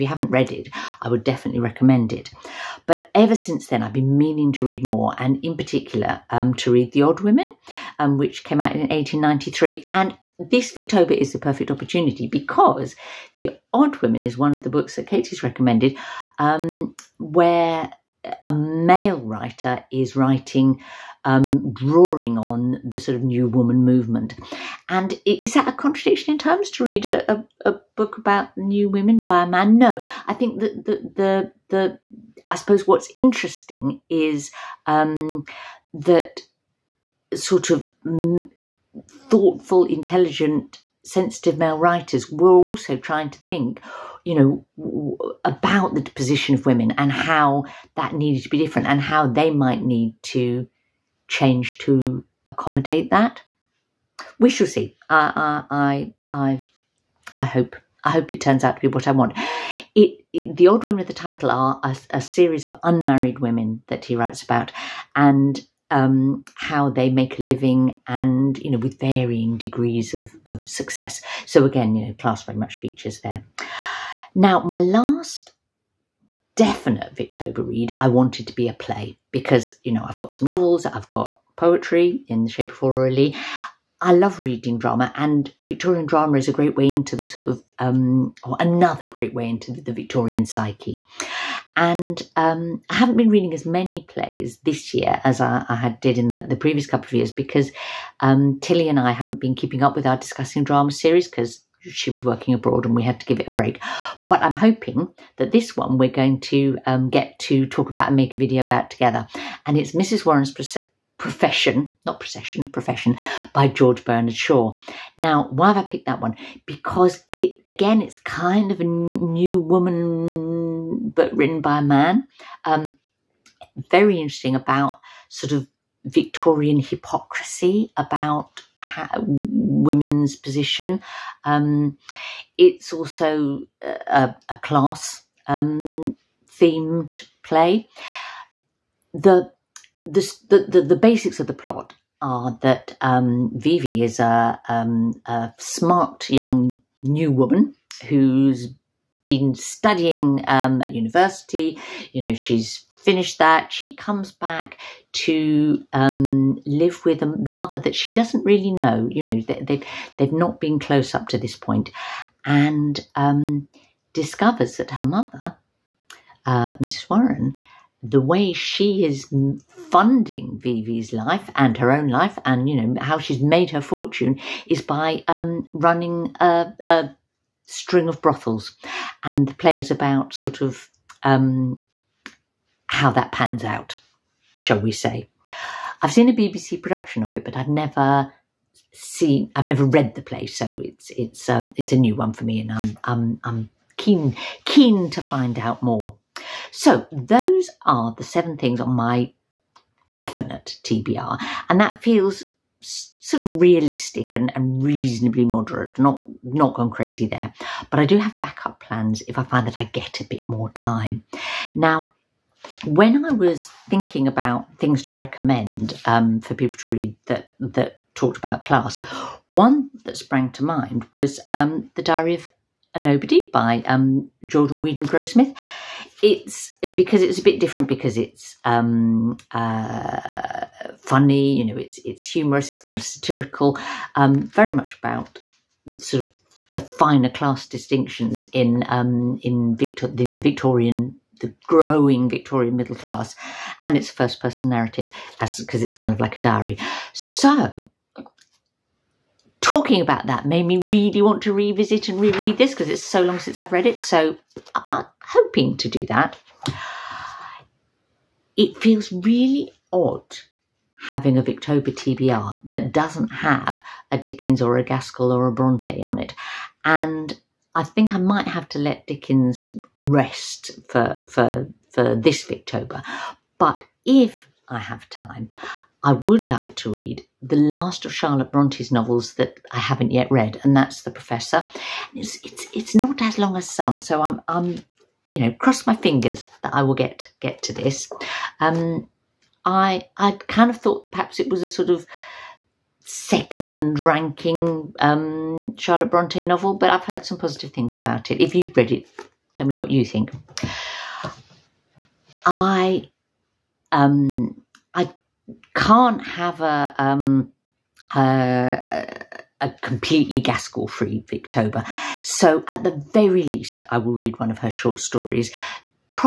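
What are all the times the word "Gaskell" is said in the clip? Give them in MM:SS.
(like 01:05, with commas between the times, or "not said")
04:24, 05:10.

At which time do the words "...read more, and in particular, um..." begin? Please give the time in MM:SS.
00:04.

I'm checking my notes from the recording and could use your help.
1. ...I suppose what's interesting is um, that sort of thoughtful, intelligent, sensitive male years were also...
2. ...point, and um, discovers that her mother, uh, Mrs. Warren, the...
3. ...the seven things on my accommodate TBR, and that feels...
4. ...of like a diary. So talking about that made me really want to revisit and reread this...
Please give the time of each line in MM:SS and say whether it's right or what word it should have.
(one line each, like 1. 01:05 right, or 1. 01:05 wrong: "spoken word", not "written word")
1. 00:32 wrong: "writers", not "years"
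2. 02:41 right
3. 03:18 wrong: "definite", not "accommodate"
4. 04:06 right.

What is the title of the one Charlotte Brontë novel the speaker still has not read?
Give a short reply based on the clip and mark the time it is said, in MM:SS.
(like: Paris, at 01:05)
The Professor, at 04:41.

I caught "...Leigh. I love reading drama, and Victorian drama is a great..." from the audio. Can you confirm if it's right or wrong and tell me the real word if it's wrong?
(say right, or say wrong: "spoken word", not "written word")
right.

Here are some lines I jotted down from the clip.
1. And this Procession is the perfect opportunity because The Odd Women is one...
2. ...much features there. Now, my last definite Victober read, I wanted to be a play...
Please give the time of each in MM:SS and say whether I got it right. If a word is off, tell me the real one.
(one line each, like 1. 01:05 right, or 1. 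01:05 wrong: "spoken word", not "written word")
1. 00:09 wrong: "Victober", not "Procession"
2. 01:12 right.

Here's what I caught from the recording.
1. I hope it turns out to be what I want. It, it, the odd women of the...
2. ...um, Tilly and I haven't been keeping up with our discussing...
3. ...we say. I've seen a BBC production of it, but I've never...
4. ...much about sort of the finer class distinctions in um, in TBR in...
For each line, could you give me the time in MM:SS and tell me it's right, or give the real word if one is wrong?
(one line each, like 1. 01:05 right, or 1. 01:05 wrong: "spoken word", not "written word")
1. 00:58 right
2. 01:38 right
3. 03:04 right
4. 03:54 wrong: "Victor", not "TBR".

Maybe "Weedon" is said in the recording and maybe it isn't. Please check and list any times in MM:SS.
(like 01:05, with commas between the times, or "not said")
03:44.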